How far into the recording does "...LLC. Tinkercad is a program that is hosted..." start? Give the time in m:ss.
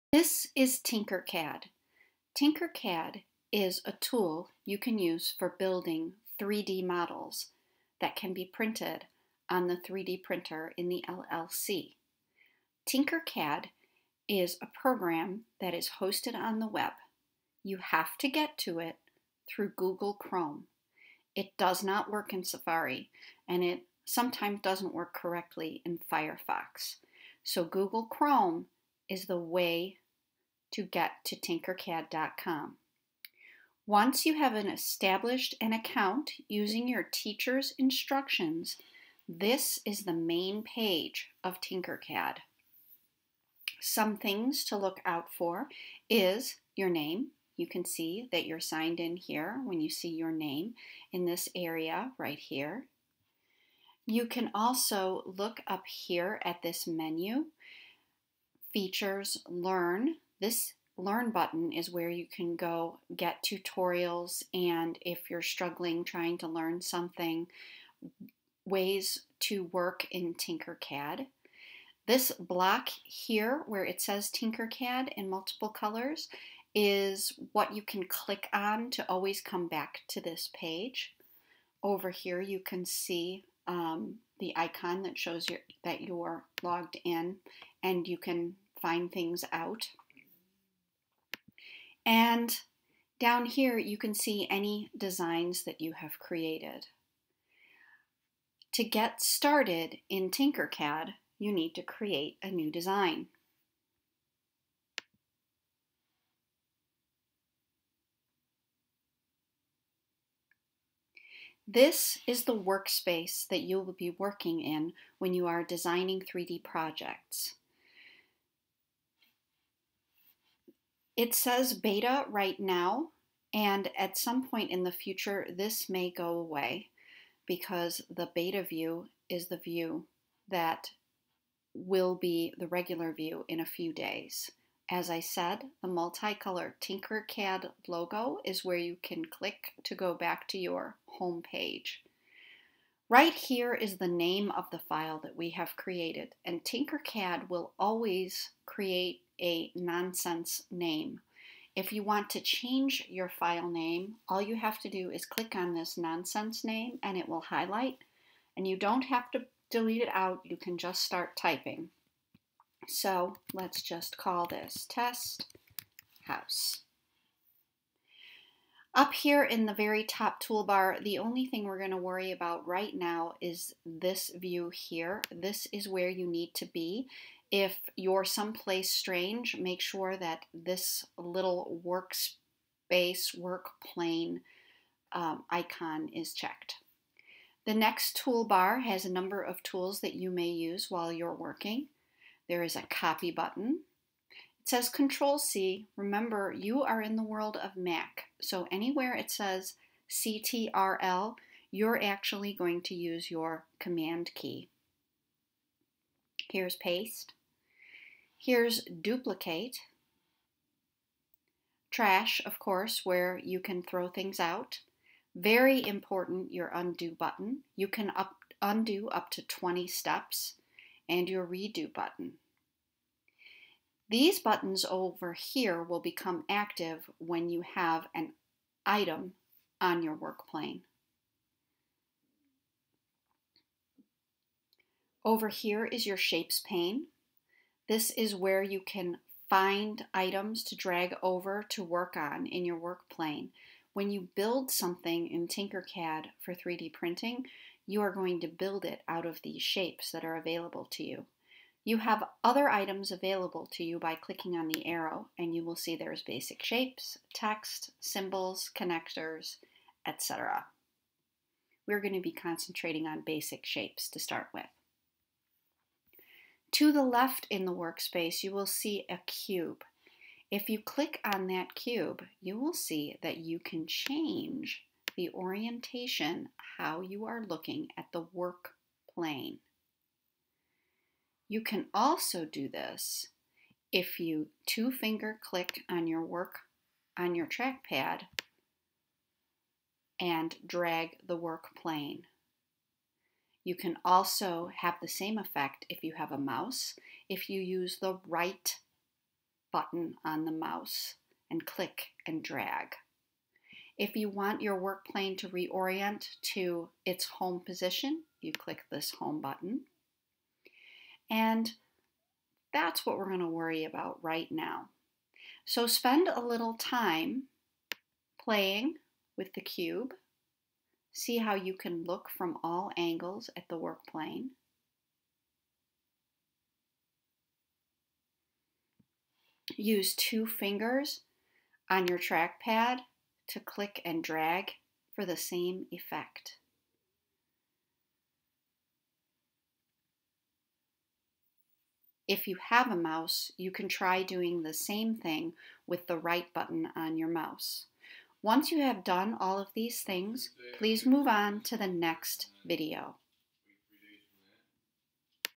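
0:11.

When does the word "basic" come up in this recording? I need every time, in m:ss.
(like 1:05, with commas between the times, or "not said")
4:16, 4:23.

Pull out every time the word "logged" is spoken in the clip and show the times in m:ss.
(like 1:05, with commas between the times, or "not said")
1:26.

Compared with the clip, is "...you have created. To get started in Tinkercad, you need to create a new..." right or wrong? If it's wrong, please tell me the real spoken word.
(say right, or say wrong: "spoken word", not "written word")
right.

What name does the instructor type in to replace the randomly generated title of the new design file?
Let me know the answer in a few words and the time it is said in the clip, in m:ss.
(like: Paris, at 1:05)
test house, at 2:44.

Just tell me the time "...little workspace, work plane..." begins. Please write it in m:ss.
3:01.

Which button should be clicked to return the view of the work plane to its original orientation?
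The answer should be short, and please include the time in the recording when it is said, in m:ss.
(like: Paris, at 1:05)
home button, at 5:09.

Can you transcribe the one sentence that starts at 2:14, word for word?
As I said, the multicolor Tinkercad logo is where you can click to go back to your home page.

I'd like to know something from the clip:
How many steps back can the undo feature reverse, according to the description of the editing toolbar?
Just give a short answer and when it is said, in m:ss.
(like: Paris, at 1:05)
20, at 3:39.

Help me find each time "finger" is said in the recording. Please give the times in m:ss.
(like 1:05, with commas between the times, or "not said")
4:44, 5:30.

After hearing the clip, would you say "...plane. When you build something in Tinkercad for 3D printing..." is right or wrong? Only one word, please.
right.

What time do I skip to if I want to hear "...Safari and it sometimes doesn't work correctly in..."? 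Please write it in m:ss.
0:22.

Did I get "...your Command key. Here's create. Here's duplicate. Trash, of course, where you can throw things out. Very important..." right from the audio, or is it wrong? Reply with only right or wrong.
wrong.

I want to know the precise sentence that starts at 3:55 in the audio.
Over here is your shapes pane.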